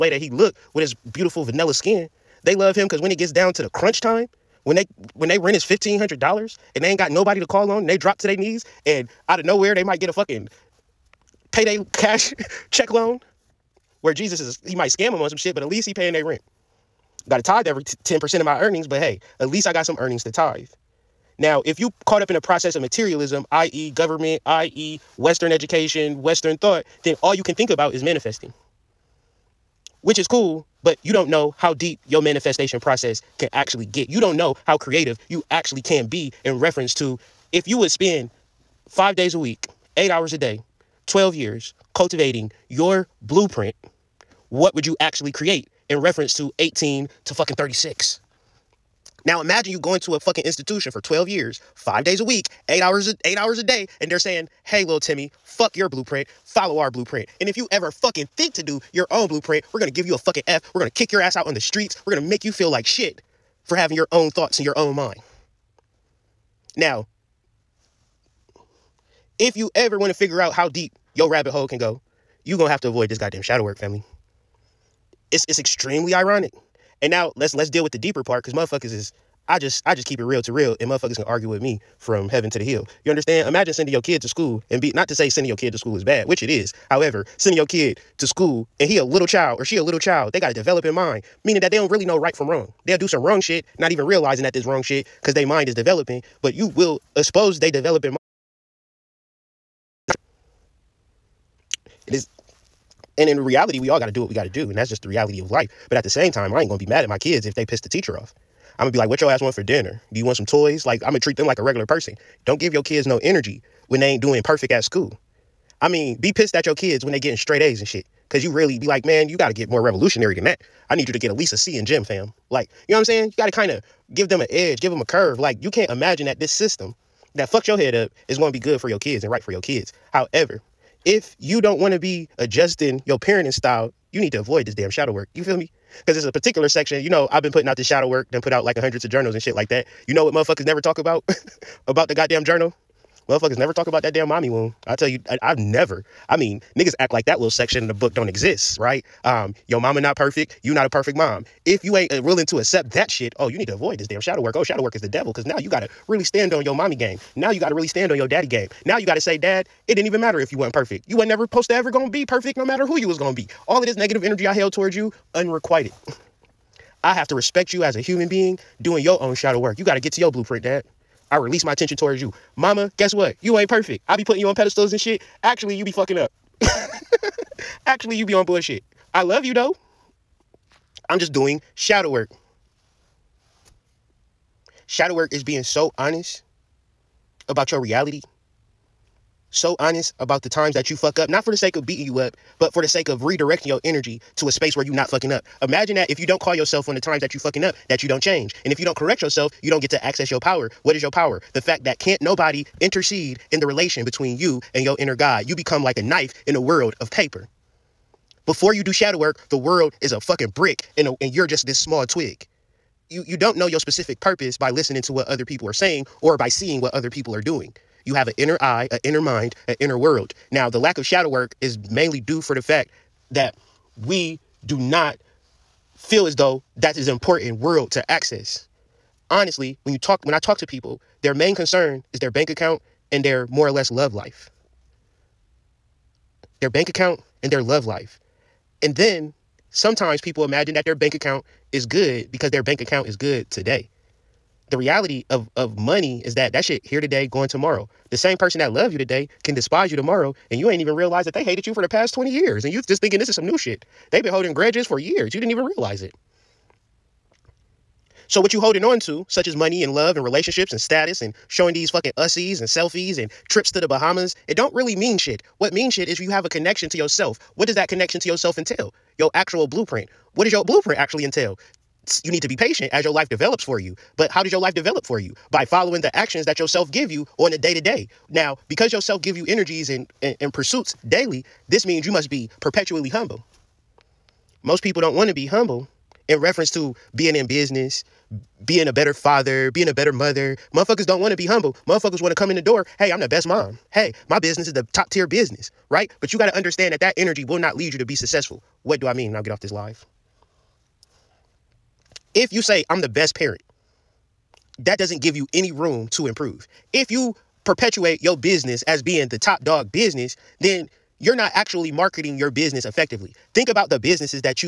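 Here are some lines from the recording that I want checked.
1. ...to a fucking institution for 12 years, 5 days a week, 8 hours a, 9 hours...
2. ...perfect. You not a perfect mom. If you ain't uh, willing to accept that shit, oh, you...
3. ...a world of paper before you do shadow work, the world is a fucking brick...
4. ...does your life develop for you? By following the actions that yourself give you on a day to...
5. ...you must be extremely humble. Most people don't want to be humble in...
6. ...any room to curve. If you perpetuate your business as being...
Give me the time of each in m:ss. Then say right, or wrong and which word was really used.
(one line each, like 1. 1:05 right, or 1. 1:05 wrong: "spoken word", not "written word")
1. 0:49 wrong: "8", not "9"
2. 2:30 right
3. 3:26 right
4. 4:34 right
5. 4:42 wrong: "perpetually", not "extremely"
6. 5:05 wrong: "improve", not "curve".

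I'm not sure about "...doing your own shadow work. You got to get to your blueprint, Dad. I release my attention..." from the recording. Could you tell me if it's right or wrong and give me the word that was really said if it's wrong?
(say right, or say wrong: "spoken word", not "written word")
right.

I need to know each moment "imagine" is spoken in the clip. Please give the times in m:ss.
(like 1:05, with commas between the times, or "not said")
0:49, 1:23, 2:05, 3:15, 4:00.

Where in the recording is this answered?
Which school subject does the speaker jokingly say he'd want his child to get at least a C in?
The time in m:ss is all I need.
2:01.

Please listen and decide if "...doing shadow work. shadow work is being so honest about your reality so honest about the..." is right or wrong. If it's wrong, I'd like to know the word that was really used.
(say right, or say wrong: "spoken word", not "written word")
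right.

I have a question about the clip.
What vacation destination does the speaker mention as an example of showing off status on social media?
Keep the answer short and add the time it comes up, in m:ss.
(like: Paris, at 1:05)
the Bahamas, at 4:23.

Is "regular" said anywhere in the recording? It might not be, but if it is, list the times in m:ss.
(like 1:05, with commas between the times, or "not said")
1:51.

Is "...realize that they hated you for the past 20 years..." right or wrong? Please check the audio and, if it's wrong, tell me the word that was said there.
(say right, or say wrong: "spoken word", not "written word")
right.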